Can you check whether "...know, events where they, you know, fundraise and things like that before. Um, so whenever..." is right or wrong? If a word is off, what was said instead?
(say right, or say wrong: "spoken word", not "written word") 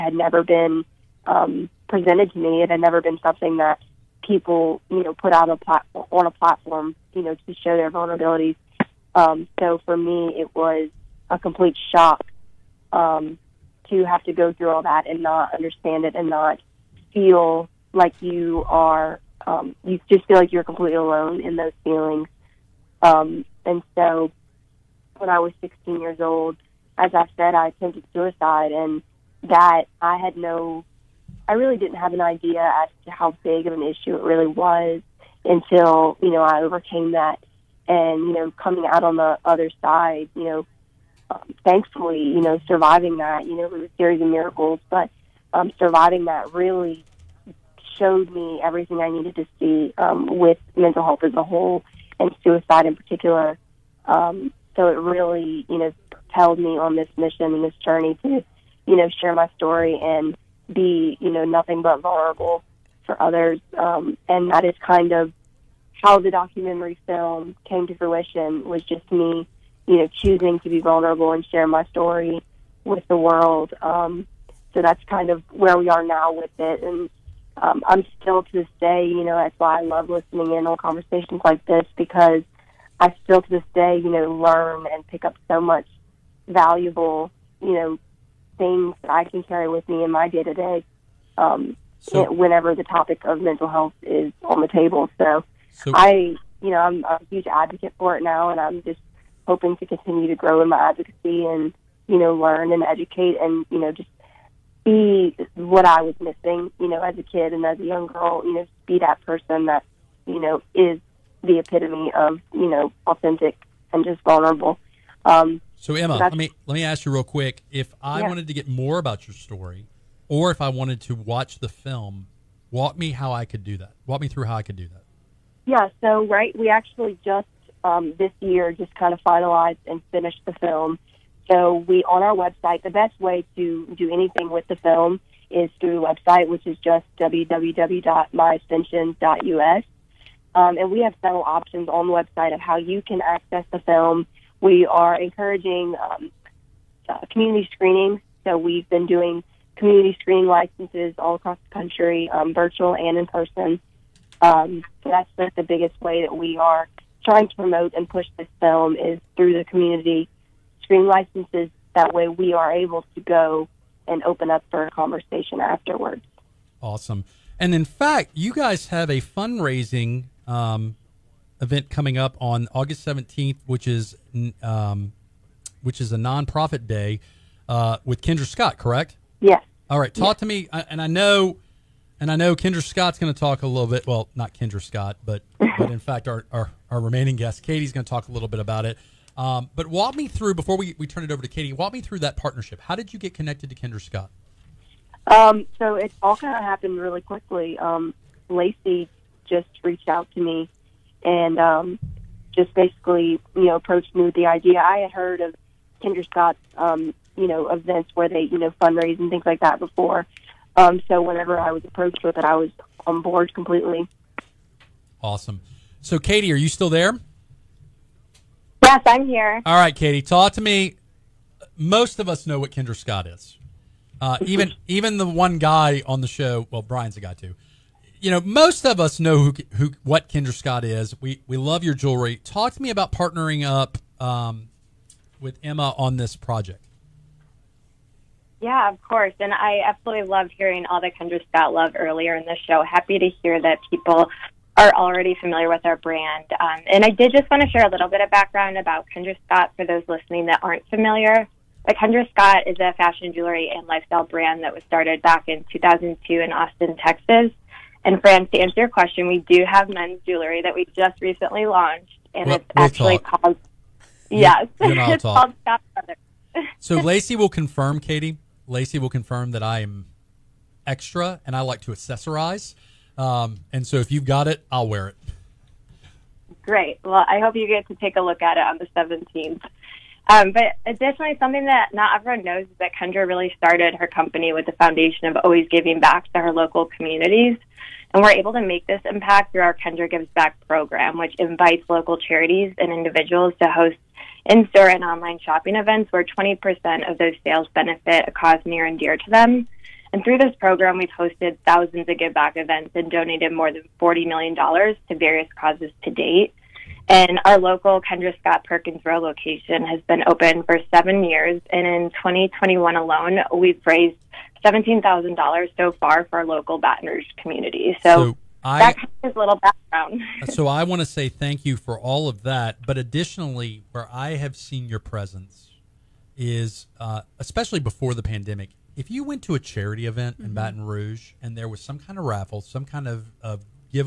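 right.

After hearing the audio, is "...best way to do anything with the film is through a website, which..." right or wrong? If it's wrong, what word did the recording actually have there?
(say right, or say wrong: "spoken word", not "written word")
right.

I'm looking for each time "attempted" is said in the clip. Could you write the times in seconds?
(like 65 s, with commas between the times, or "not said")
27 s.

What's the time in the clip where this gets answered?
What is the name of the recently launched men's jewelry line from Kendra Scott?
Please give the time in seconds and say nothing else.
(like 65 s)
265 s.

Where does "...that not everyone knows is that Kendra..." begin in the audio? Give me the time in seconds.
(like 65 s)
281 s.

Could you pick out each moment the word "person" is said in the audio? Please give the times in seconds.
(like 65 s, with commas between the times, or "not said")
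109 s, 153 s.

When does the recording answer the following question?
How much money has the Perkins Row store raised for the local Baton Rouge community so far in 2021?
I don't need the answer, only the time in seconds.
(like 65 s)
314 s.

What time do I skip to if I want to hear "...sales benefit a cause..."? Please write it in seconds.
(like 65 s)
297 s.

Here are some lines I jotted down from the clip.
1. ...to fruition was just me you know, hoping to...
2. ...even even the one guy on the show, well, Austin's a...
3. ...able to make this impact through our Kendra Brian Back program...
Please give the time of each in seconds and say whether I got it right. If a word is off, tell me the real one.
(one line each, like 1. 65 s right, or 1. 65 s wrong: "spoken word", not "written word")
1. 67 s wrong: "choosing", not "hoping"
2. 224 s wrong: "Brian", not "Austin"
3. 288 s wrong: "Gives", not "Brian".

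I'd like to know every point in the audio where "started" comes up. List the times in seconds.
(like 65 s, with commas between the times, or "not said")
254 s, 283 s.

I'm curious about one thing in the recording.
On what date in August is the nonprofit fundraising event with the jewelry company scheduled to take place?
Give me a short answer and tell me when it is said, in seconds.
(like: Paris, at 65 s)
August 17th, at 172 s.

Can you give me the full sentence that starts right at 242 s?
Happy to hear that people are already familiar with our brand.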